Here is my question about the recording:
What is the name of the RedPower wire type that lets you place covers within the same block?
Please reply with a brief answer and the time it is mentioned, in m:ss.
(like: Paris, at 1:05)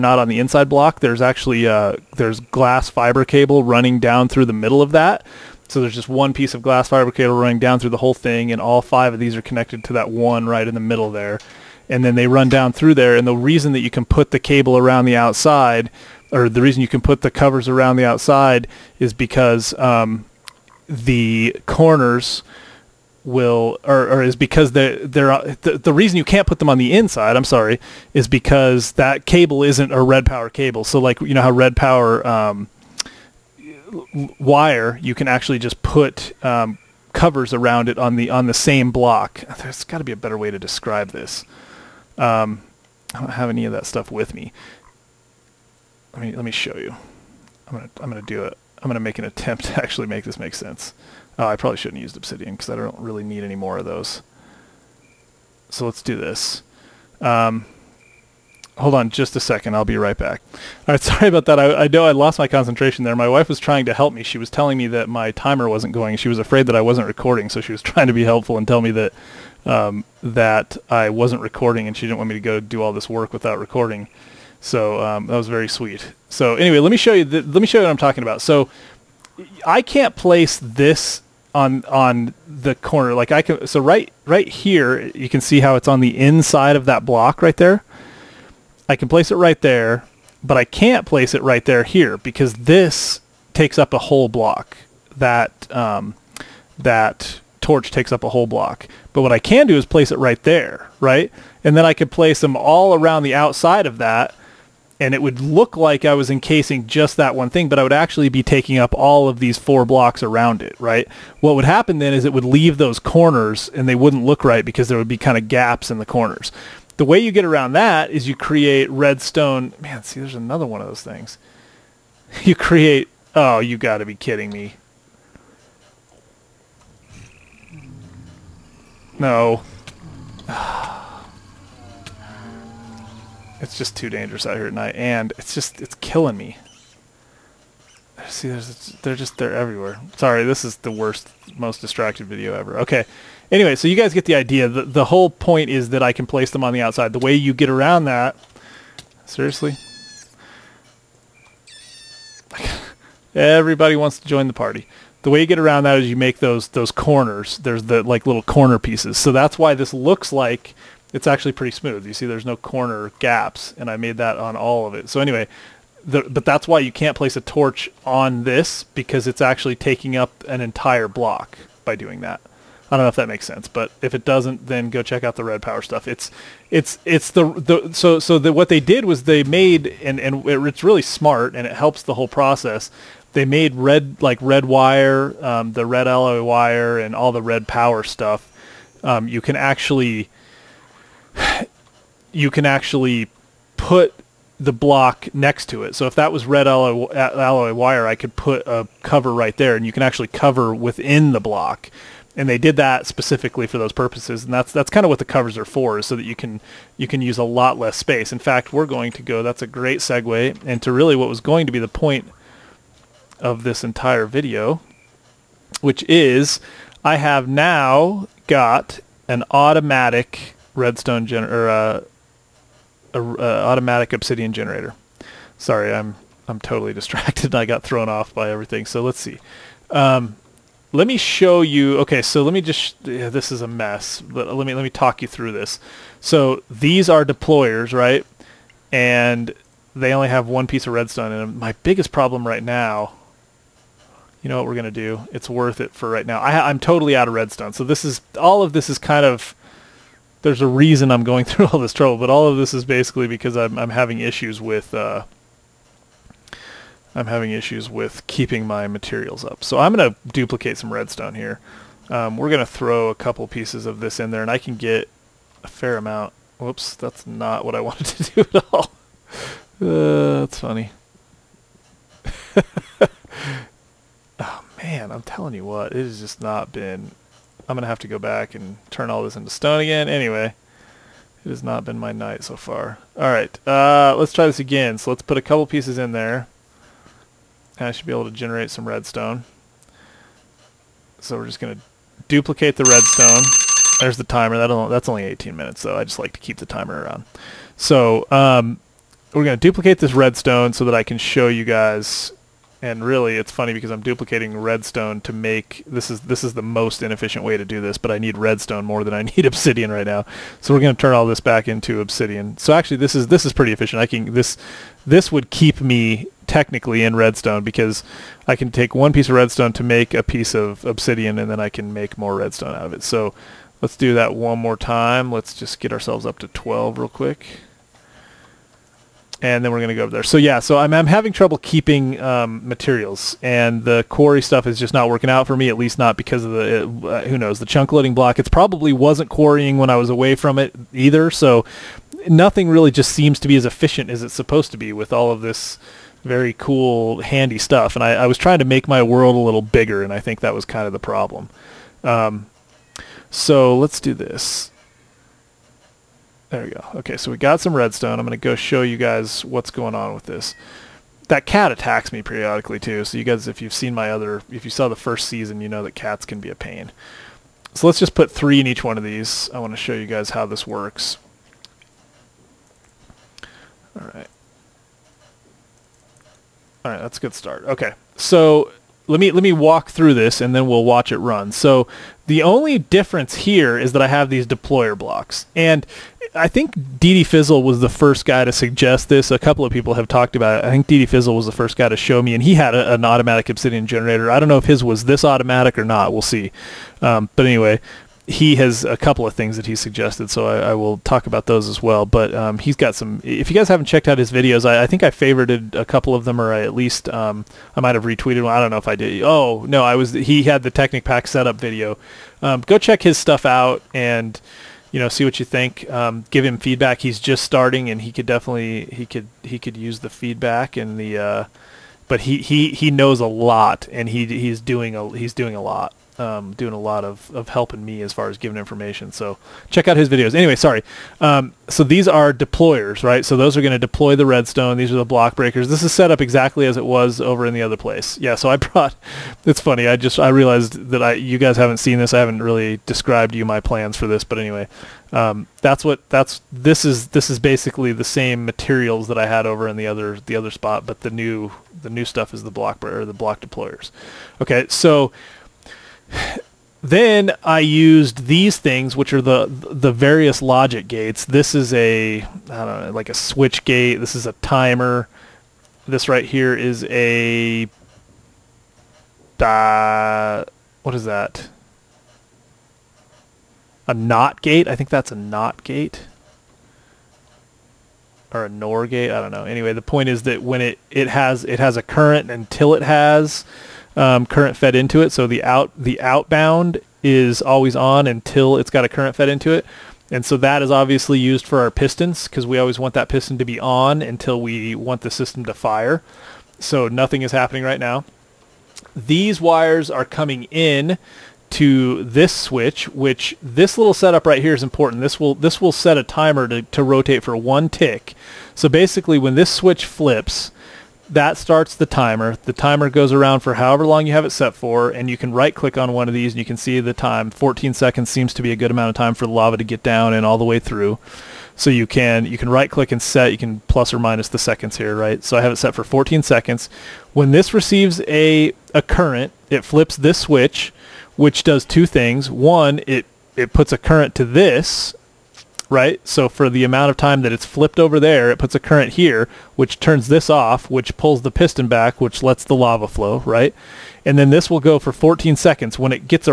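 red alloy wire, at 3:05.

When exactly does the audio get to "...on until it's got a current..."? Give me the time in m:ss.
8:07.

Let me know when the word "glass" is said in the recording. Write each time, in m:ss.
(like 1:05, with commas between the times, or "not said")
0:02, 0:06.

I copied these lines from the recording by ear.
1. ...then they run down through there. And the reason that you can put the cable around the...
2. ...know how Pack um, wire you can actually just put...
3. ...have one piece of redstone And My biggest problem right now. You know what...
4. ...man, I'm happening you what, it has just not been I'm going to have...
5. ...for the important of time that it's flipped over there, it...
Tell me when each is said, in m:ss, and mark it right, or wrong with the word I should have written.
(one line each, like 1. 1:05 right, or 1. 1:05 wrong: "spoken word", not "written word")
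1. 0:12 right
2. 0:31 wrong: "RedPower", not "Pack"
3. 4:00 right
4. 4:34 wrong: "telling", not "happening"
5. 8:56 wrong: "amount", not "important".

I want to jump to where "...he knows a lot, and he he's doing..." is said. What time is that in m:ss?
7:02.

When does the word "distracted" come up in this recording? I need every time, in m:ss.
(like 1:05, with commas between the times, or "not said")
2:21, 3:46.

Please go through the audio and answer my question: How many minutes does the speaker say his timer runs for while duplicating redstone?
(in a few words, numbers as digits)
18.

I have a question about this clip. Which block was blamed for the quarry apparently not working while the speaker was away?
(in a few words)
chunk loading block.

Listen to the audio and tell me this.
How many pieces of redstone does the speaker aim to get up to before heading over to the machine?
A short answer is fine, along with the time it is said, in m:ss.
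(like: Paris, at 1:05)
12, at 5:26.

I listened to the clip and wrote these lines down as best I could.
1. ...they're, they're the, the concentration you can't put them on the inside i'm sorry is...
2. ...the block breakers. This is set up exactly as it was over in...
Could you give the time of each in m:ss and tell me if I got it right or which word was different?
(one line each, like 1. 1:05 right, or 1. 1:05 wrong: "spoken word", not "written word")
1. 0:24 wrong: "reason", not "concentration"
2. 7:14 right.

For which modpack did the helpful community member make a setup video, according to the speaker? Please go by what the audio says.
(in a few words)
Technic Pack.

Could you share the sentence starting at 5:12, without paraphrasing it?
So actually, this is this is pretty efficient.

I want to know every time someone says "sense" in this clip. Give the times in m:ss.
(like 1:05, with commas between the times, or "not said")
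0:50, 2:53.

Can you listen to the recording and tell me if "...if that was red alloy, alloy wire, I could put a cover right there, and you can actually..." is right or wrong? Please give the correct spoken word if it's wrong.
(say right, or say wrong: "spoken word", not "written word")
right.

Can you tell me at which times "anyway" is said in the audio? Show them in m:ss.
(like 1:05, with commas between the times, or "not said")
1:16, 2:23, 2:45, 4:40, 6:37, 7:10, 7:24, 7:59.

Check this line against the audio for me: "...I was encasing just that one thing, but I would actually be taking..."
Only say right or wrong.
right.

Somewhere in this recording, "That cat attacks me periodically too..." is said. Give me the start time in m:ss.
6:01.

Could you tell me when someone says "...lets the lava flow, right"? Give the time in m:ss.
9:02.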